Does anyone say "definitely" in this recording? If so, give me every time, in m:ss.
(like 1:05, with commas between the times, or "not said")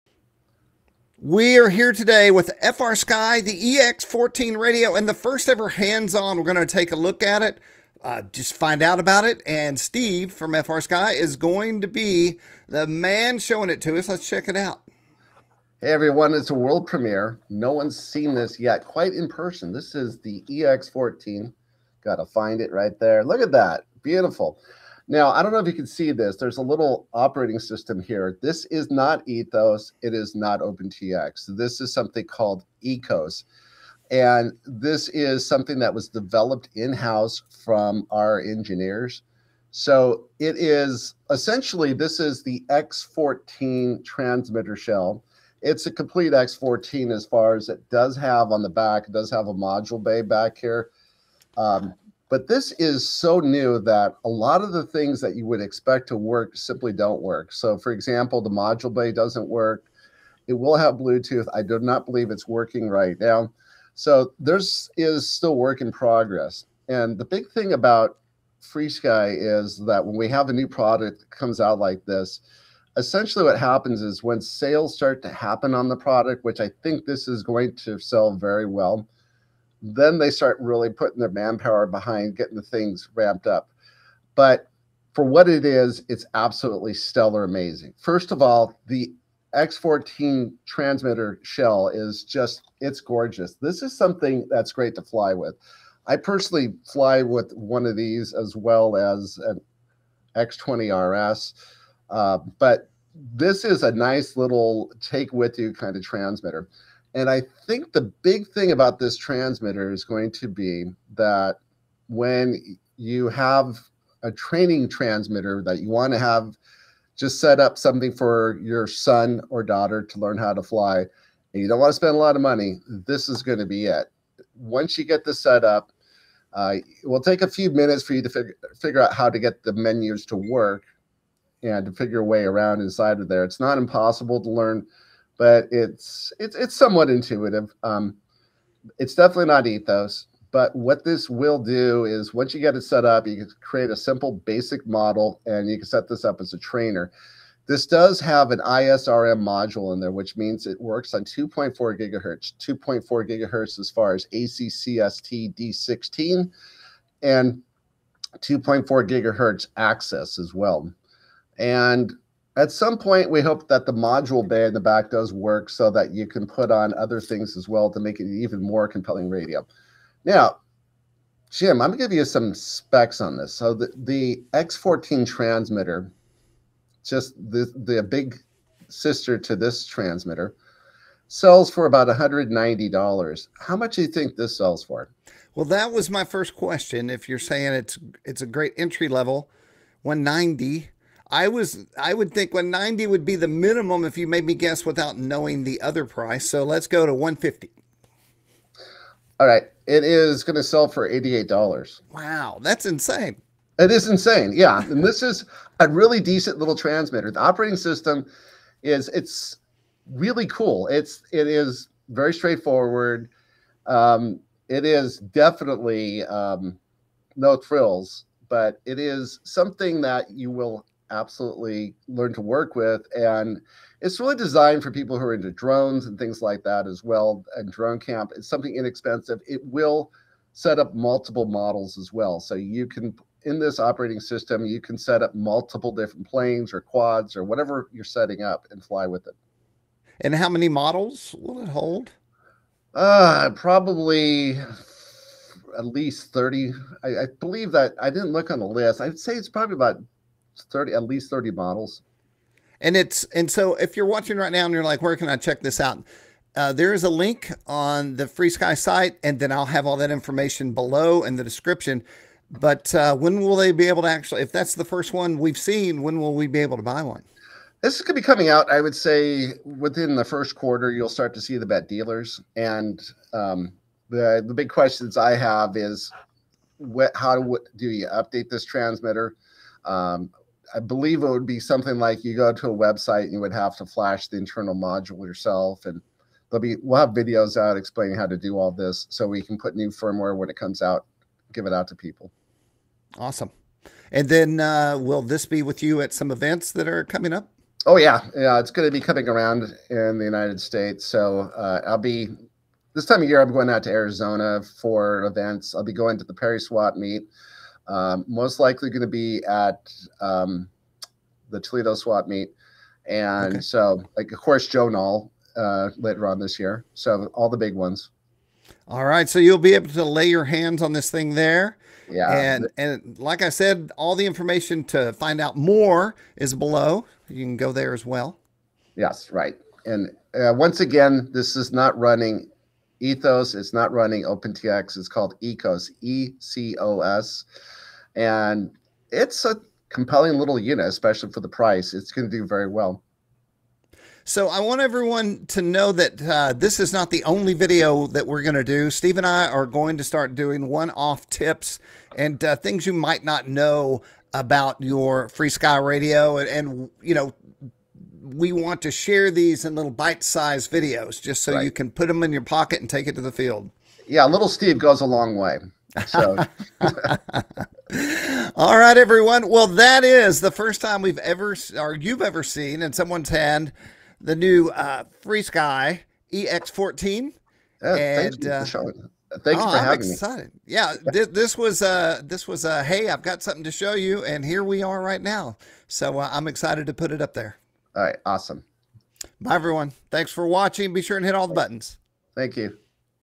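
2:19, 3:35.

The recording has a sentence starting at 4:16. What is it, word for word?
Uh, there is a link on the FrSky site, and then I'll have all that information below in the description.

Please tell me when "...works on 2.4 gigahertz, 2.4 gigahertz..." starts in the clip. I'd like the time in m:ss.
2:30.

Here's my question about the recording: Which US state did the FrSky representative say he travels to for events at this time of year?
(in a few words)
Arizona.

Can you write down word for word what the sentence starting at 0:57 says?
So, for example, the module bay doesn't work.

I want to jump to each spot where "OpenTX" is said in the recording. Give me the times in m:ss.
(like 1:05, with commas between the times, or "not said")
0:30, 5:34.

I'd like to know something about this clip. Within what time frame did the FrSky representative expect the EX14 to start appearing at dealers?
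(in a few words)
first quarter.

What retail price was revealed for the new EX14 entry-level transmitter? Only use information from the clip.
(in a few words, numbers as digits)
$88.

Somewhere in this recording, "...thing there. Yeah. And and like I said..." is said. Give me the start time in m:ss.
5:21.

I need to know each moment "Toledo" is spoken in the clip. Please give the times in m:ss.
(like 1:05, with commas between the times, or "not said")
5:11.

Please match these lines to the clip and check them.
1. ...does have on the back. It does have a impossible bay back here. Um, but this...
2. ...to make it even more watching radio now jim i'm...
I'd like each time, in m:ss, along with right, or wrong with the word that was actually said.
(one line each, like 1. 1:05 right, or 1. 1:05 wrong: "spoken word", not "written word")
1. 0:47 wrong: "module", not "impossible"
2. 2:47 wrong: "compelling", not "watching".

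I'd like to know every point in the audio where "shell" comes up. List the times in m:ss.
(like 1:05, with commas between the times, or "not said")
0:44, 1:31.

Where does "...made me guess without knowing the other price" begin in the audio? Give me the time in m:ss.
3:14.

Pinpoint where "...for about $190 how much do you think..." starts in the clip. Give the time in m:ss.
3:01.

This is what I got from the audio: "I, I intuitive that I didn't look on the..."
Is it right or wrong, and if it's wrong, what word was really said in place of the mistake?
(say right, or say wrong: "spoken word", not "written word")
wrong: "believe", not "intuitive".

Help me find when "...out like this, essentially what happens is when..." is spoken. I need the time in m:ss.
1:11.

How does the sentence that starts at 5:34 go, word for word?
It's called ECOS, E C O S.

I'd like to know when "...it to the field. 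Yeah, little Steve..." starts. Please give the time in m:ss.
6:03.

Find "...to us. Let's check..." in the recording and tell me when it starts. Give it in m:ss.
0:13.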